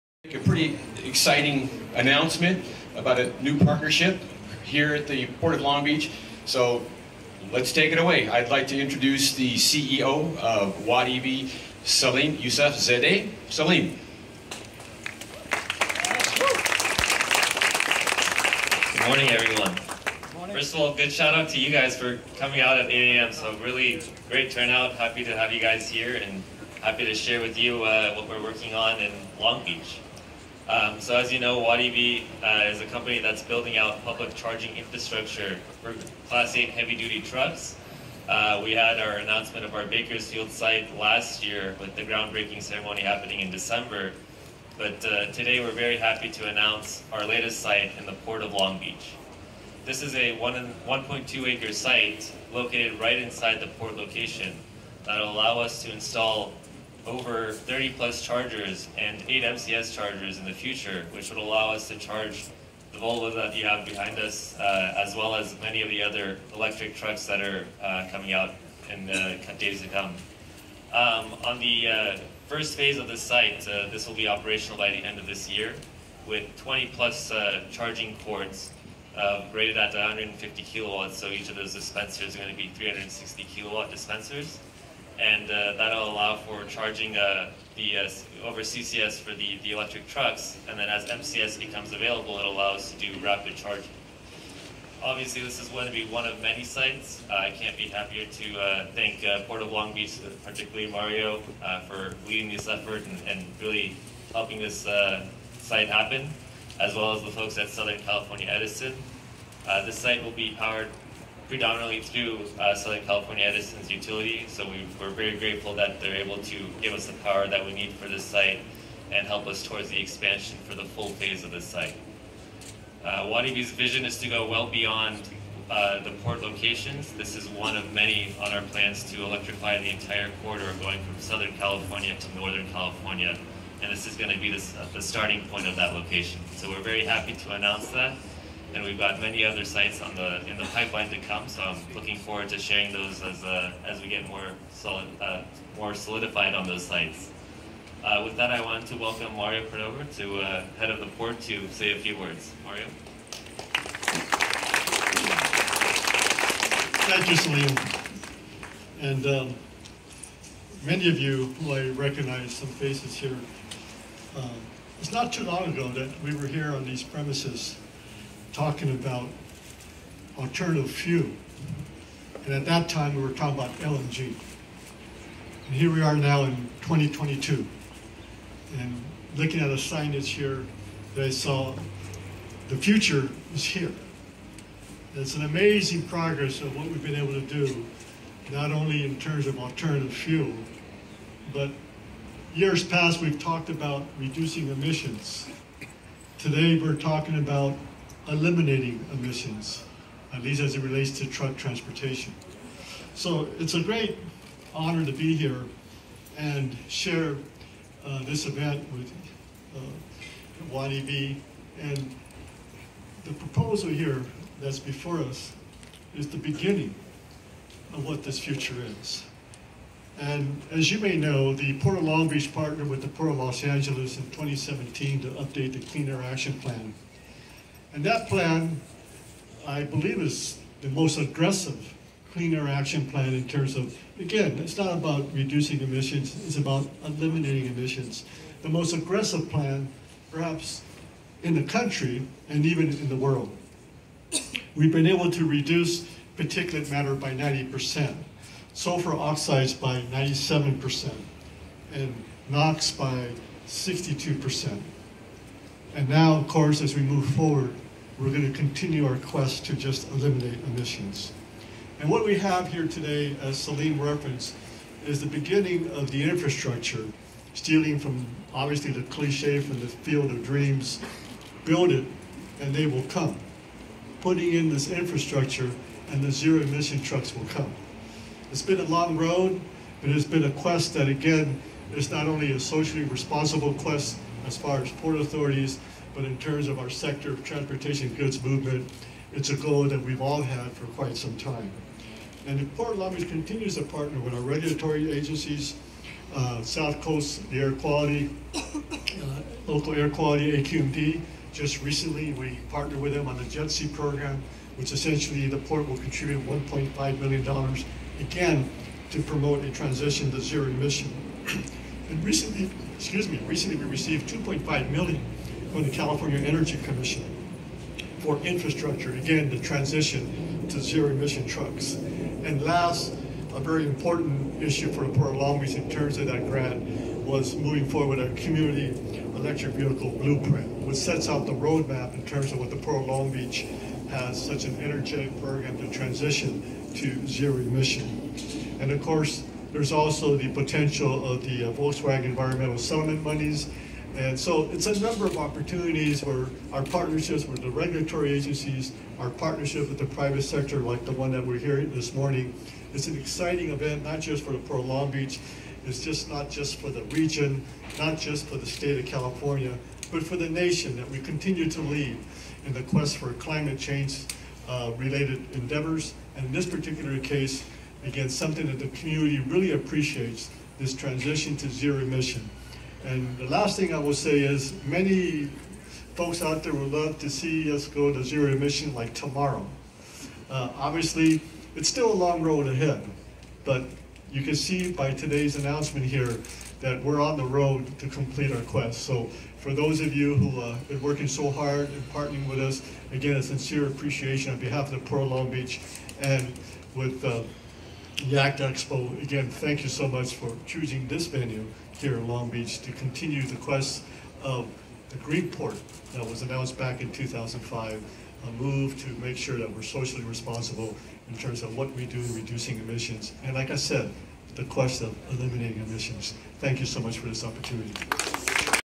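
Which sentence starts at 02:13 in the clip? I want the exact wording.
And this is going to be uh, the starting point of that location.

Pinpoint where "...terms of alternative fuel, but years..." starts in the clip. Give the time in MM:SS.
03:09.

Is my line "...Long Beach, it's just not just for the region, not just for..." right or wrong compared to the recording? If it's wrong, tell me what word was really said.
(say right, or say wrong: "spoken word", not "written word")
right.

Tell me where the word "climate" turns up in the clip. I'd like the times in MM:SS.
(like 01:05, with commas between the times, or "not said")
06:03.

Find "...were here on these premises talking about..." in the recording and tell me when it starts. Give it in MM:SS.
02:46.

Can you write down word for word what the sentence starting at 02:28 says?
Uh, with that, I want to welcome Mario Cordero to uh, head of the port to say a few words.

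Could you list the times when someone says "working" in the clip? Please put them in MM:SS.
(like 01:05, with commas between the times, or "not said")
00:28, 06:31.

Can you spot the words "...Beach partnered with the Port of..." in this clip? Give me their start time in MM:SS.
03:42.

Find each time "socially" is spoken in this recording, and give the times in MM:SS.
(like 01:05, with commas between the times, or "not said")
04:42, 06:49.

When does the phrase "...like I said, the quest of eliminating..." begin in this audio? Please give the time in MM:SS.
06:53.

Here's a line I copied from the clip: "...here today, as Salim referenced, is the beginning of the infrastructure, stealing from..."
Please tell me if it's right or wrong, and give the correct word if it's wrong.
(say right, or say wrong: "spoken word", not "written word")
right.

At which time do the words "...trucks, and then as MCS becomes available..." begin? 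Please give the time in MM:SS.
01:30.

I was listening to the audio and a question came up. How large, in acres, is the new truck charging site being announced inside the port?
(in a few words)
1.2 acres.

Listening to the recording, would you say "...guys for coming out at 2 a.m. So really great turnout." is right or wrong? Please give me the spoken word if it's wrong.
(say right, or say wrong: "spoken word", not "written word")
wrong: "8", not "2".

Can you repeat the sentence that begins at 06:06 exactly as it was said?
And in this particular case, again, something that the community really appreciates, this transition to zero emission.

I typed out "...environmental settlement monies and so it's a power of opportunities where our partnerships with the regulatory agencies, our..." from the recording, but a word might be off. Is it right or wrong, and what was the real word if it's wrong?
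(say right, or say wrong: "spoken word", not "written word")
wrong: "number", not "power".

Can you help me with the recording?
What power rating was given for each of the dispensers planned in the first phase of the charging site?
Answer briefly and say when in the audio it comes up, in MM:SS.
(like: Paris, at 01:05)
360 kilowatts, at 01:22.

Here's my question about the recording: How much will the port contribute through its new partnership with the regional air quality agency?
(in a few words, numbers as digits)
$1.5 million.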